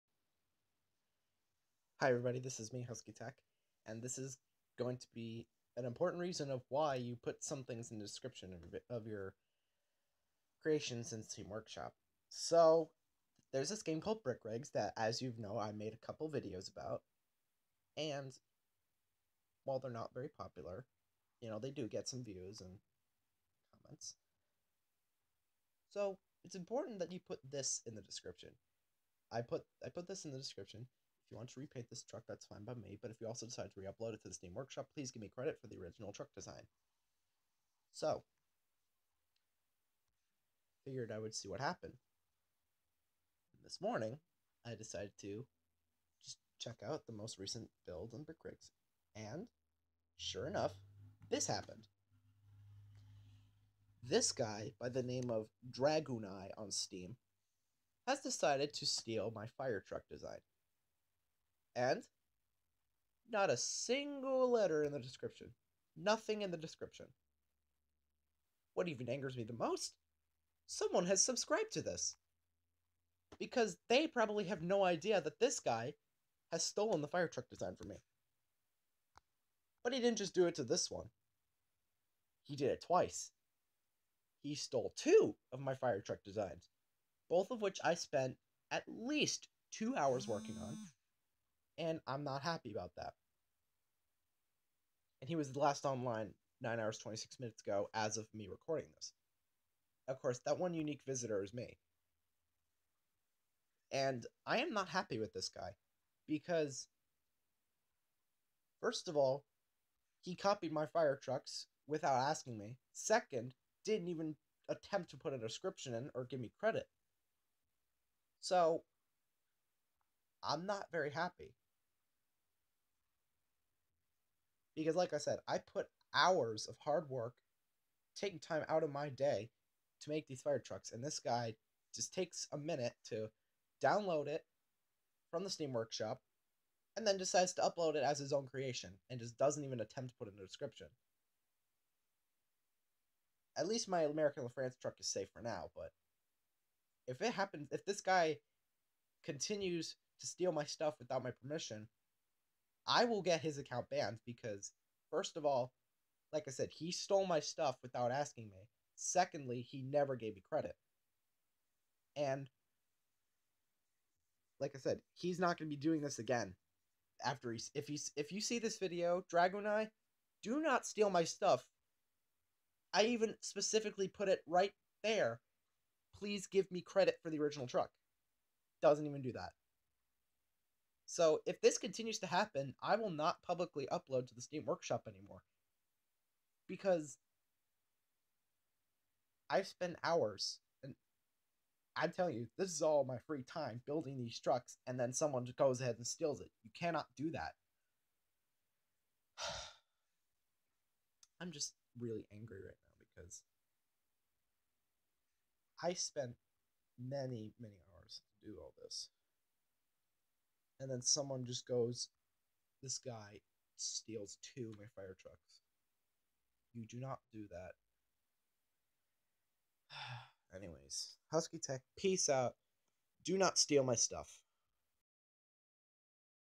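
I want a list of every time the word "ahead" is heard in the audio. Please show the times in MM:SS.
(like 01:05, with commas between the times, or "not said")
03:15.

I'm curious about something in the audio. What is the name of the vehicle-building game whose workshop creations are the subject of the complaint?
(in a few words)
Brick Rigs.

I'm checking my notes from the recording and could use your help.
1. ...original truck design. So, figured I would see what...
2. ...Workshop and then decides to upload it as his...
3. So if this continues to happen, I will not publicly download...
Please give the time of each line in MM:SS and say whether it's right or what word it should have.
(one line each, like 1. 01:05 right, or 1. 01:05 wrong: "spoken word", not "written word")
1. 00:35 right
2. 02:15 right
3. 03:01 wrong: "upload", not "download".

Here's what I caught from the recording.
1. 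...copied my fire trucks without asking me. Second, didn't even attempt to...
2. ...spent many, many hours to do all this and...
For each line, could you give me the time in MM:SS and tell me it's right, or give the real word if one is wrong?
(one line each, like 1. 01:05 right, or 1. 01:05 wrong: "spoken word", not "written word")
1. 01:50 right
2. 03:25 right.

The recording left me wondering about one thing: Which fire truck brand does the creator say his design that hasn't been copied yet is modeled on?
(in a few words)
American LaFrance.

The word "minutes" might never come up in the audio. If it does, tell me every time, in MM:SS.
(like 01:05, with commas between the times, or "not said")
01:37, 02:12.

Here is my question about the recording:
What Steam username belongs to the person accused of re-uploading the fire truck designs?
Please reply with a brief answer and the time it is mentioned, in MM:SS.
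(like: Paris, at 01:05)
dragooneye, at 00:55.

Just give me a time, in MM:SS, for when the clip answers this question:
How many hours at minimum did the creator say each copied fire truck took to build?
01:29.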